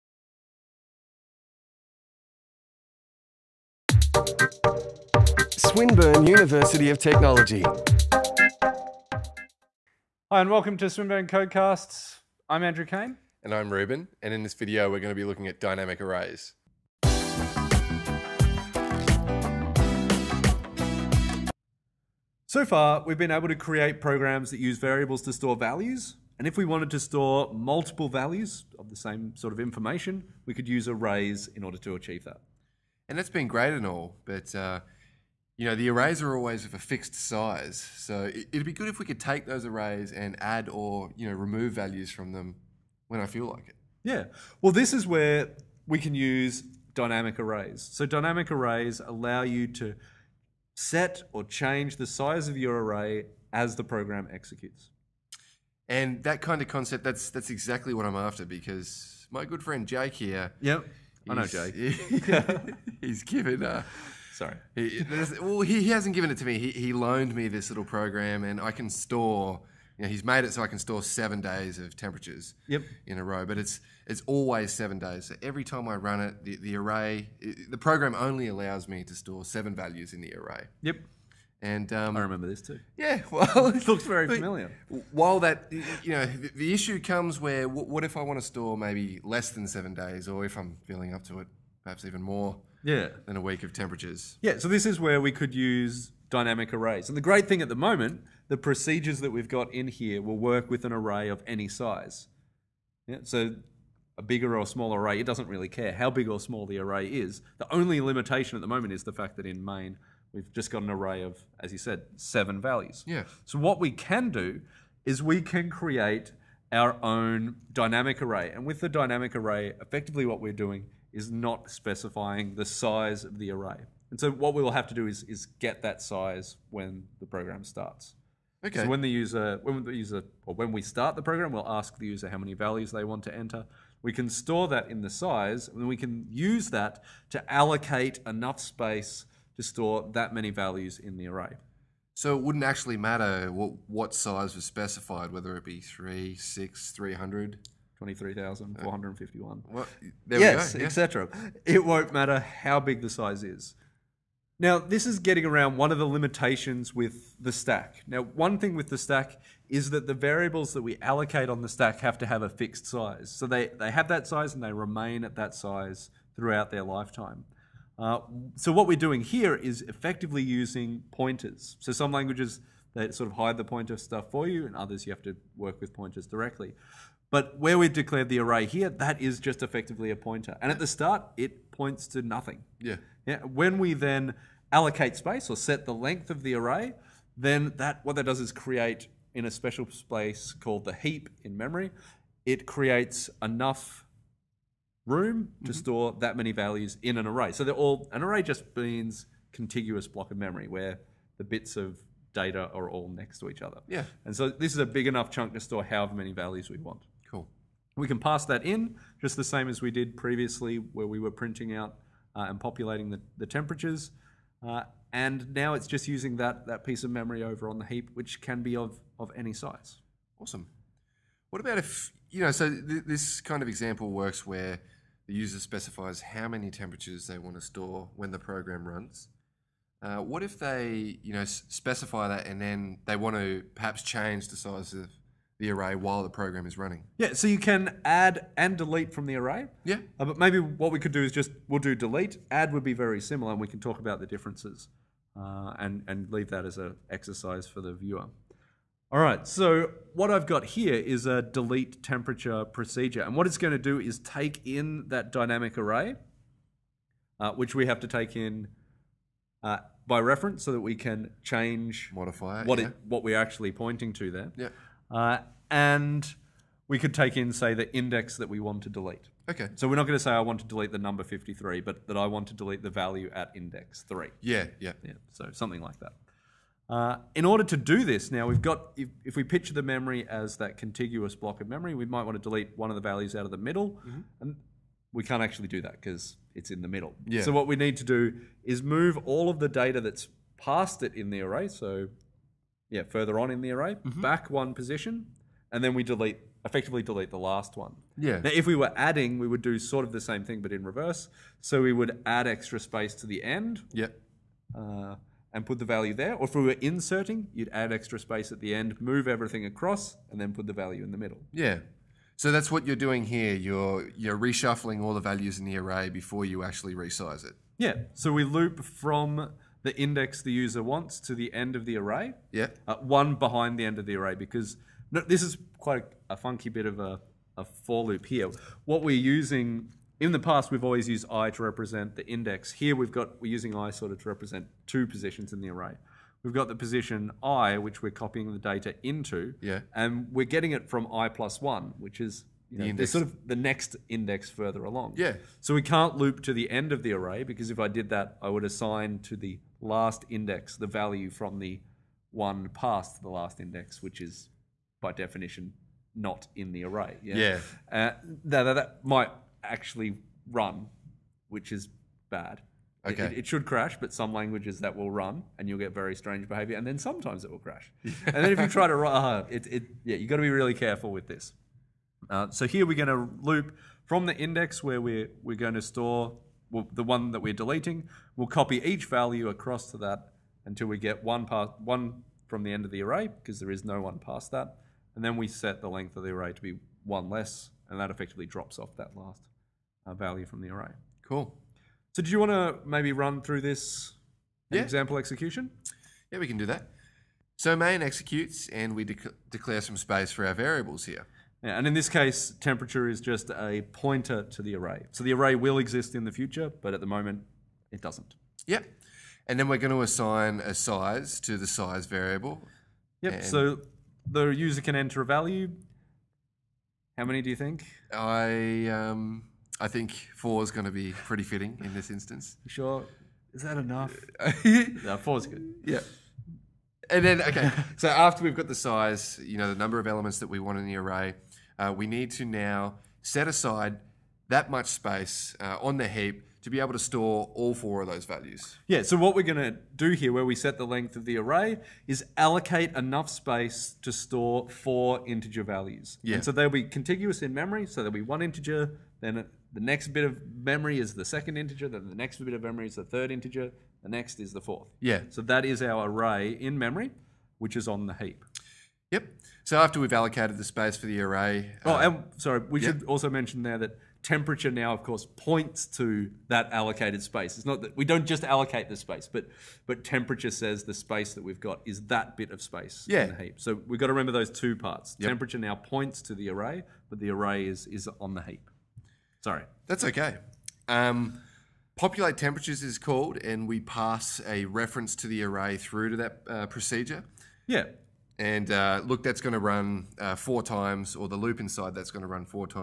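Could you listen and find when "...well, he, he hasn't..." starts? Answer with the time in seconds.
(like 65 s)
65 s.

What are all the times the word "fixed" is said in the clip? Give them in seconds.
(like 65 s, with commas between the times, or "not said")
36 s, 162 s.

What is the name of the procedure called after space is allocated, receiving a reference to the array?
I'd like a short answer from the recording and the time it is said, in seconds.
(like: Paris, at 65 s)
Populate temperatures, at 481 s.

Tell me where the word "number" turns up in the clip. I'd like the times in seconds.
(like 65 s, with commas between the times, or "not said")
270 s, 429 s.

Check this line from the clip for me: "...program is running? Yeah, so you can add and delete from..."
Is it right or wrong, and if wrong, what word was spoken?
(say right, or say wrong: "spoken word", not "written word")
right.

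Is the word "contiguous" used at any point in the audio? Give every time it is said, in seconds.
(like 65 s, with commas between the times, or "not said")
199 s, 280 s, 446 s.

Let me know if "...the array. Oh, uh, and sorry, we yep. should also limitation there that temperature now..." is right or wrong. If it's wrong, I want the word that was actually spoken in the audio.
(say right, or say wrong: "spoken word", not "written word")
wrong: "mention", not "limitation".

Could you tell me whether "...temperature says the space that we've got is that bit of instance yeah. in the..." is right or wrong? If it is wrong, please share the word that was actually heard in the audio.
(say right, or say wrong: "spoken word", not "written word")
wrong: "space", not "instance".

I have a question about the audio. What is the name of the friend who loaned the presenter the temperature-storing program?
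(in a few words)
Jake.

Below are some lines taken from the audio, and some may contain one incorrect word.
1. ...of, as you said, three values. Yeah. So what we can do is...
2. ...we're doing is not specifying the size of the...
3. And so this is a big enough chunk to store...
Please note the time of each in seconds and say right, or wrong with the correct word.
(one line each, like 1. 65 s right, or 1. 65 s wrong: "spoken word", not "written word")
1. 111 s wrong: "seven", not "three"
2. 120 s right
3. 204 s right.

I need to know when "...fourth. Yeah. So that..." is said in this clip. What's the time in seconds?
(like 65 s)
454 s.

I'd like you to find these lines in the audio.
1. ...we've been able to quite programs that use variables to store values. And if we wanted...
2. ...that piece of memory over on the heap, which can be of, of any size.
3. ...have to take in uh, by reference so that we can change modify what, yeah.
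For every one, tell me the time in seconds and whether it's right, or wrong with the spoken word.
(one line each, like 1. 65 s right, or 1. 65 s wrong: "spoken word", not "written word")
1. 23 s wrong: "create", not "quite"
2. 216 s right
3. 257 s right.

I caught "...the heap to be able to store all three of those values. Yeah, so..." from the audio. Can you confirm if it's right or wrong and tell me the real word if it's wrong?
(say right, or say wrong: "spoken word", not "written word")
wrong: "four", not "three".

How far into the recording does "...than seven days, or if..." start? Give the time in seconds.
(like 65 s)
89 s.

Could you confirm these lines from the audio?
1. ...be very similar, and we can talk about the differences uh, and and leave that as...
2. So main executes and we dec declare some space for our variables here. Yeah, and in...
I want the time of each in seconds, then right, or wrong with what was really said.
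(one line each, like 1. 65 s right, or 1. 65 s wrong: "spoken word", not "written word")
1. 242 s right
2. 397 s right.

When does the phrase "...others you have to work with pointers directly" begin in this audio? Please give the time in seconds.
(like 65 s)
174 s.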